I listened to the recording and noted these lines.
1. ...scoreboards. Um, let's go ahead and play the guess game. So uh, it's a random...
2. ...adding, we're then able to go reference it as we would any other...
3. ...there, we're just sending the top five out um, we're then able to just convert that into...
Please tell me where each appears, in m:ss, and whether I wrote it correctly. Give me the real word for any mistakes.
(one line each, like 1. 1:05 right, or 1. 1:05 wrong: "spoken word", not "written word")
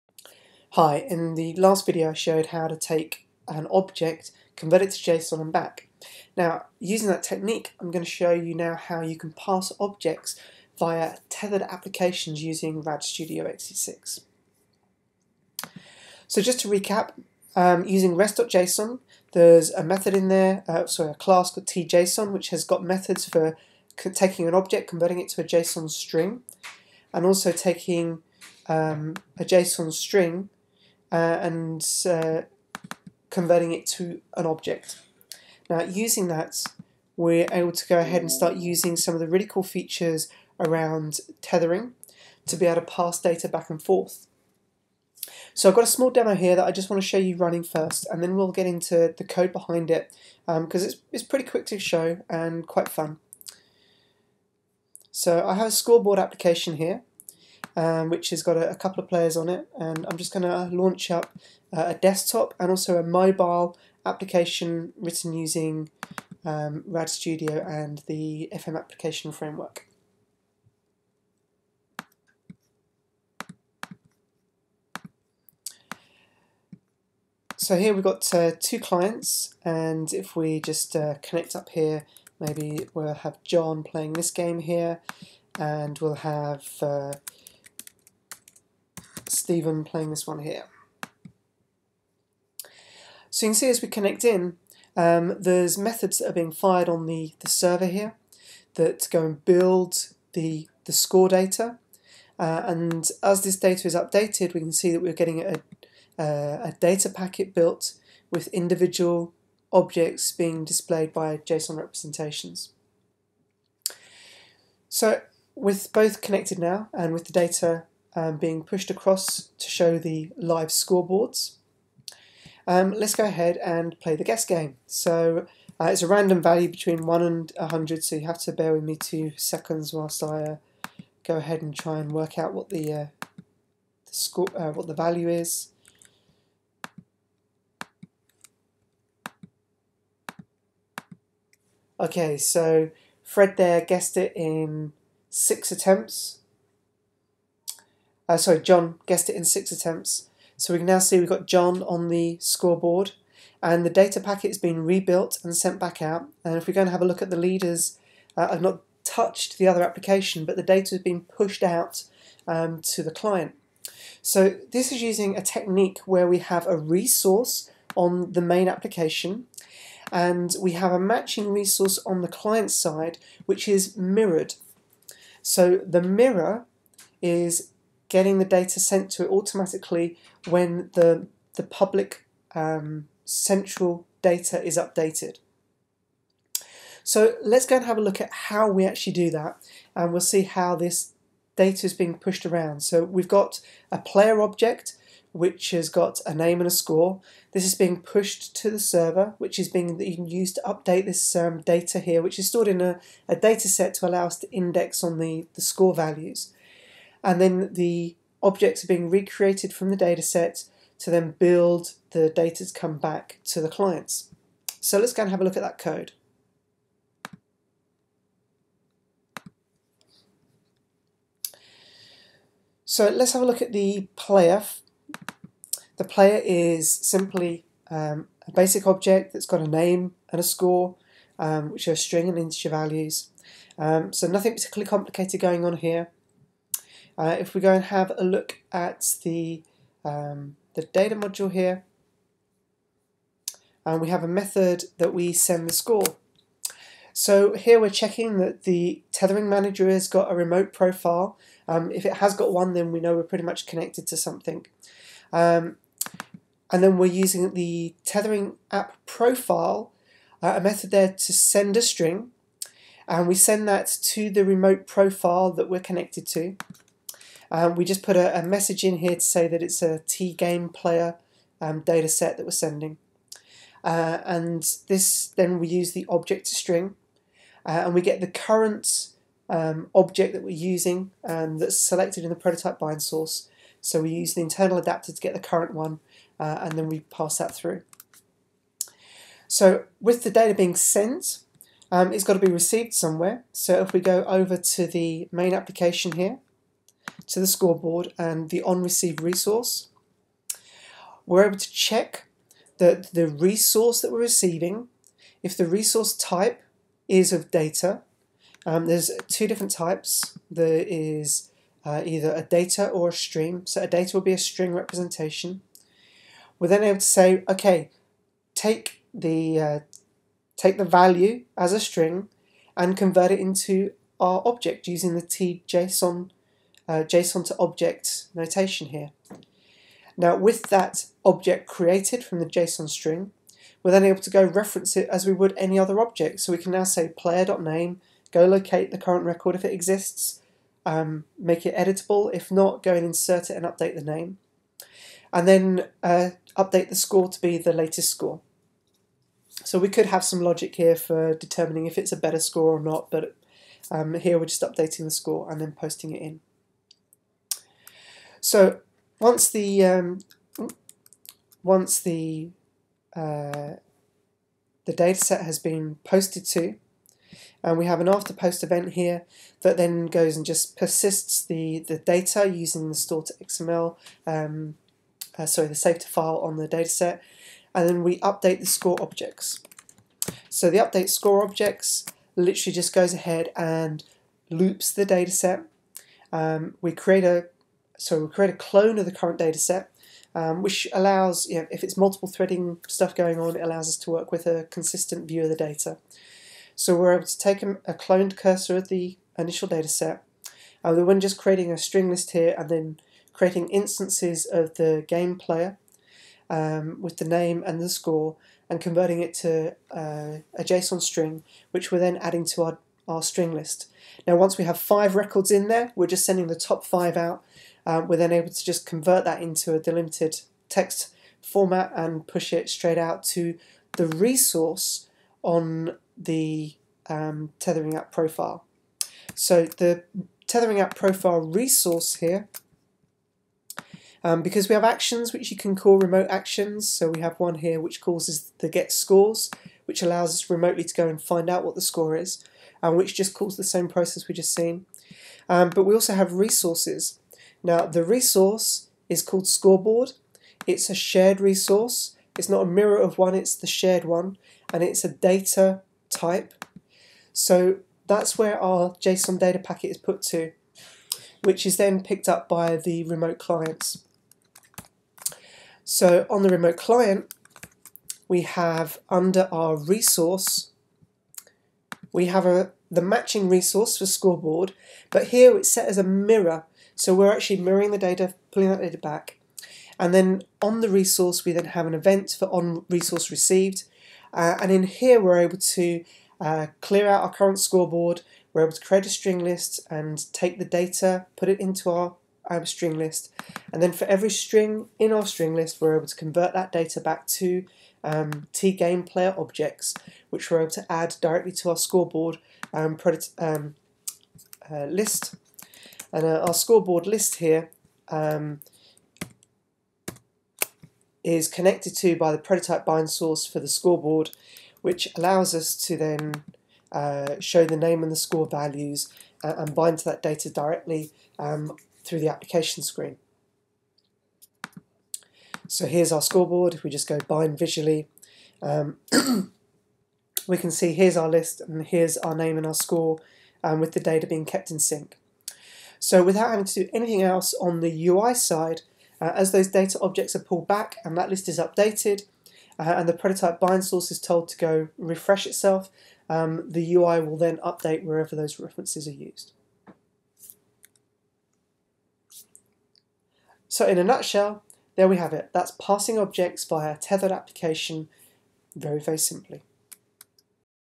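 1. 2:00 right
2. 5:32 wrong: "string", not "adding"
3. 6:55 right.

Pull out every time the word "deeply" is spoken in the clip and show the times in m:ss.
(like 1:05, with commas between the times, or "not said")
not said.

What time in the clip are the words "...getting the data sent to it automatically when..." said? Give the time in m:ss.
2:58.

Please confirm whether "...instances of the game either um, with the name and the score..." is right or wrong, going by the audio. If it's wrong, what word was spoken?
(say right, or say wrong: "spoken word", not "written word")
wrong: "player", not "either".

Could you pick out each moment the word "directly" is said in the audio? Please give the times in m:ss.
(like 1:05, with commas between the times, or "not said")
8:21, 8:40.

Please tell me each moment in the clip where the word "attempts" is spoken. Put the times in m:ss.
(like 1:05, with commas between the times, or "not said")
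2:25, 2:29.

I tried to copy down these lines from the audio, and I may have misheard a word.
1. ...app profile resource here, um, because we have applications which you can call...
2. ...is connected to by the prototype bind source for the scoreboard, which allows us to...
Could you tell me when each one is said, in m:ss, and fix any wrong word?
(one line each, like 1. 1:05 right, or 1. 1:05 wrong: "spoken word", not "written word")
1. 7:10 wrong: "actions", not "applications"
2. 8:31 right.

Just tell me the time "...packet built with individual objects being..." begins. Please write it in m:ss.
1:47.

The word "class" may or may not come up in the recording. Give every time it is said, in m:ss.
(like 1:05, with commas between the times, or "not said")
0:21.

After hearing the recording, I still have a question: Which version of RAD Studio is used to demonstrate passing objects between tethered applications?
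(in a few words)
XE6.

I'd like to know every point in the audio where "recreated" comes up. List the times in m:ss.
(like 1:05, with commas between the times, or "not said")
3:29.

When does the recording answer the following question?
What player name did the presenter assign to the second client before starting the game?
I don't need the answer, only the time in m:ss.
1:29.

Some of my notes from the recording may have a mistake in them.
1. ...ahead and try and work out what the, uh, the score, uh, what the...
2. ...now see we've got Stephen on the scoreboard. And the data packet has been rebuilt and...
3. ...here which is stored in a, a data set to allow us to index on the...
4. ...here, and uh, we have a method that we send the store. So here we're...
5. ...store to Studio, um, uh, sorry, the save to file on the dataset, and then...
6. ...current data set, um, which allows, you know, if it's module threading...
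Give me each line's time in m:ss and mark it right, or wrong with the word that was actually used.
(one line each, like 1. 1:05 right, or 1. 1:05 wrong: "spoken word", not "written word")
1. 2:11 right
2. 2:30 wrong: "John", not "Stephen"
3. 3:22 right
4. 4:01 wrong: "score", not "store"
5. 6:12 wrong: "XML", not "Studio"
6. 6:29 wrong: "multiple", not "module".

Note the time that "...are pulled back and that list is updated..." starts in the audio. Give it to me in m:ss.
9:00.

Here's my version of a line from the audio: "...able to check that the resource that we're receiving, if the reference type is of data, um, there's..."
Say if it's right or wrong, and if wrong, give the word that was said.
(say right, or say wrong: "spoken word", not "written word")
wrong: "resource", not "reference".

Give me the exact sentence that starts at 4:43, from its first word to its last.
So we use the internal adapter to get the current one uh, and then we pass that through.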